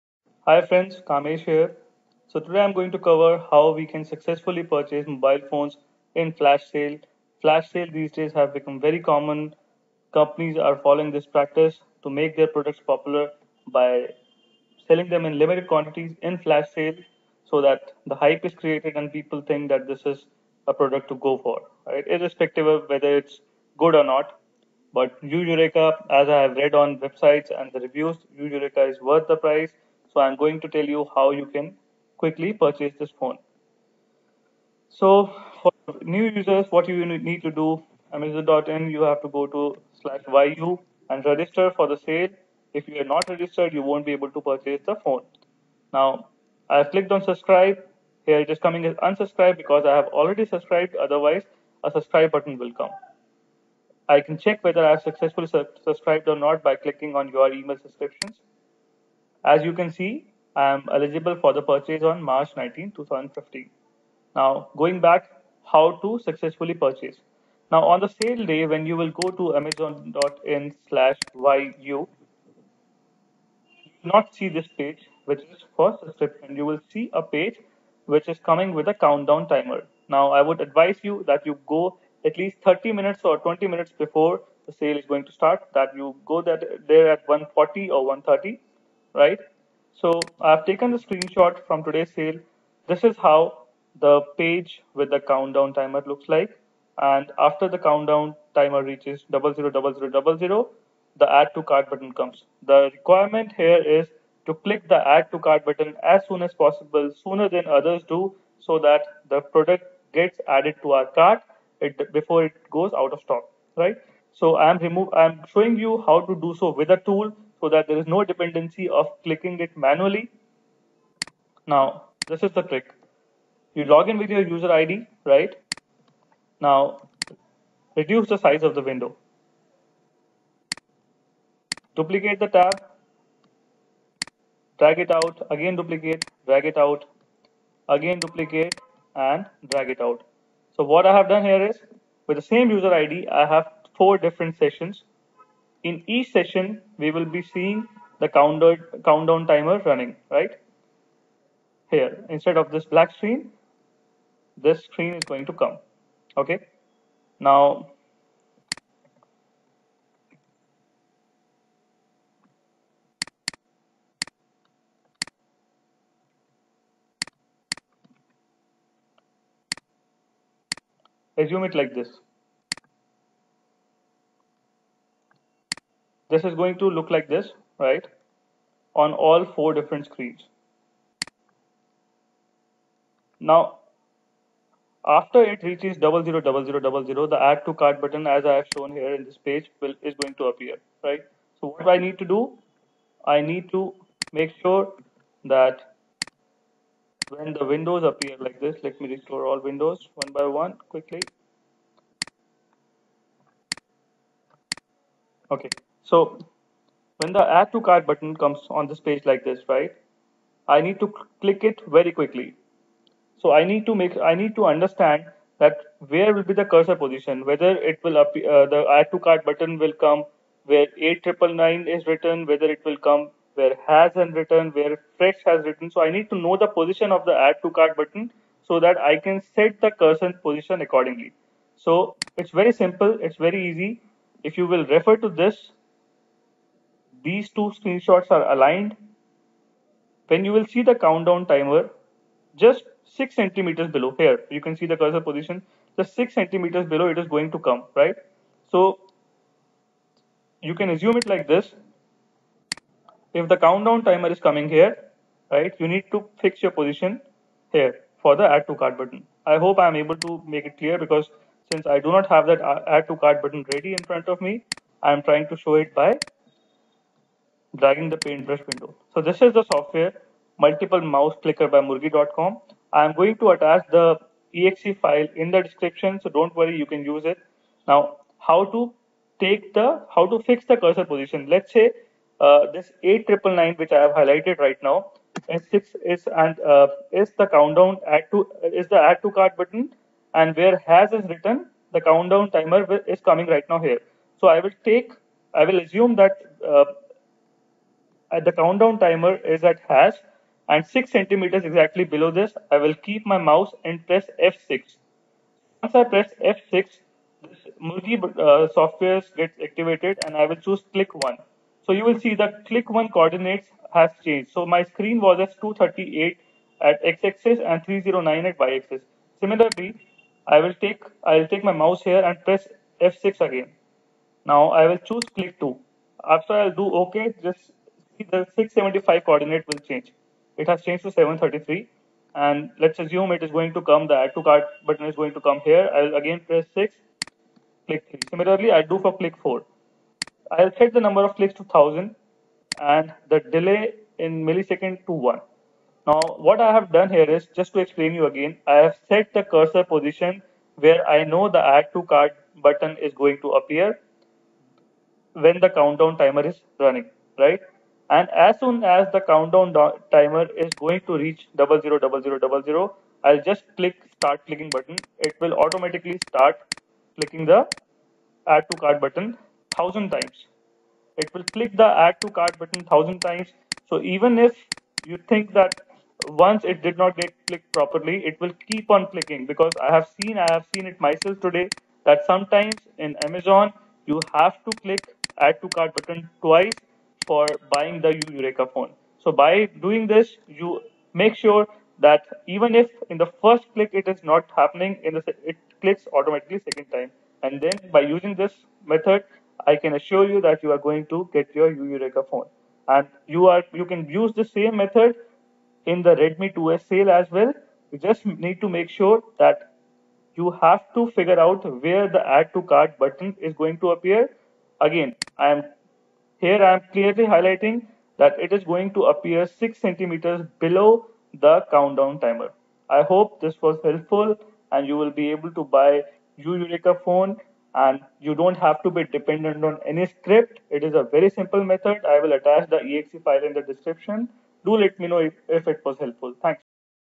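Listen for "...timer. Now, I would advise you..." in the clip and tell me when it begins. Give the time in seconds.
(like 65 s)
79 s.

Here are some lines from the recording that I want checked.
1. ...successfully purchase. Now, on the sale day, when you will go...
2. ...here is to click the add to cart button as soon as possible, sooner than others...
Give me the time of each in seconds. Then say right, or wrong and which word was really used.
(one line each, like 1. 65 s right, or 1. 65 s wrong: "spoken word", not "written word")
1. 66 s right
2. 103 s right.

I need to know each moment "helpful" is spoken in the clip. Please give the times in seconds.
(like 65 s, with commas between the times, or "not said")
423 s, 435 s.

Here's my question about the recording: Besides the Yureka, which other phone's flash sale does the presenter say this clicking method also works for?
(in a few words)
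Redmi 2S.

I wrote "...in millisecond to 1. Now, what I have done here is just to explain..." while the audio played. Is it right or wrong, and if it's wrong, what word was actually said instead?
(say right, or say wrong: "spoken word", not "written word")
right.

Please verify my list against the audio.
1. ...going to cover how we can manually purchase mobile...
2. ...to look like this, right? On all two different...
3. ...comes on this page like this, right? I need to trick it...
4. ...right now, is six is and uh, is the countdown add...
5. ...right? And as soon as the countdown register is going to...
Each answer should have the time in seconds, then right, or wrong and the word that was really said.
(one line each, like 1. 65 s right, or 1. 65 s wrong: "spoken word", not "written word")
1. 2 s wrong: "successfully", not "manually"
2. 176 s wrong: "four", not "two"
3. 208 s wrong: "click", not "trick"
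4. 284 s right
5. 357 s wrong: "timer", not "register".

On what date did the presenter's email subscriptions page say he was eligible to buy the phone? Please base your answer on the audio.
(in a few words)
March 19, 2015.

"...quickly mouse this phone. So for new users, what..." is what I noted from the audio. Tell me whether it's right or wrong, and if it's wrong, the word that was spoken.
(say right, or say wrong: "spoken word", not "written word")
wrong: "purchase", not "mouse".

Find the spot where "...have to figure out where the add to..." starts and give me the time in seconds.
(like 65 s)
410 s.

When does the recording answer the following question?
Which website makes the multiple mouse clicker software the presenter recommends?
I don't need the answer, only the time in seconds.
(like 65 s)
271 s.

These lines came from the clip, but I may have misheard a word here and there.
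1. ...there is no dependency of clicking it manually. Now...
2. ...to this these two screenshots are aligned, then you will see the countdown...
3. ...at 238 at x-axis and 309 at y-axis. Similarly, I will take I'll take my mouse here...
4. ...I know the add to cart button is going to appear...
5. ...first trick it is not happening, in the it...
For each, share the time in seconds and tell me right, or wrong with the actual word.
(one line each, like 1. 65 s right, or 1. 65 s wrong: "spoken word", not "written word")
1. 117 s right
2. 235 s right
3. 315 s right
4. 351 s right
5. 393 s wrong: "click", not "trick".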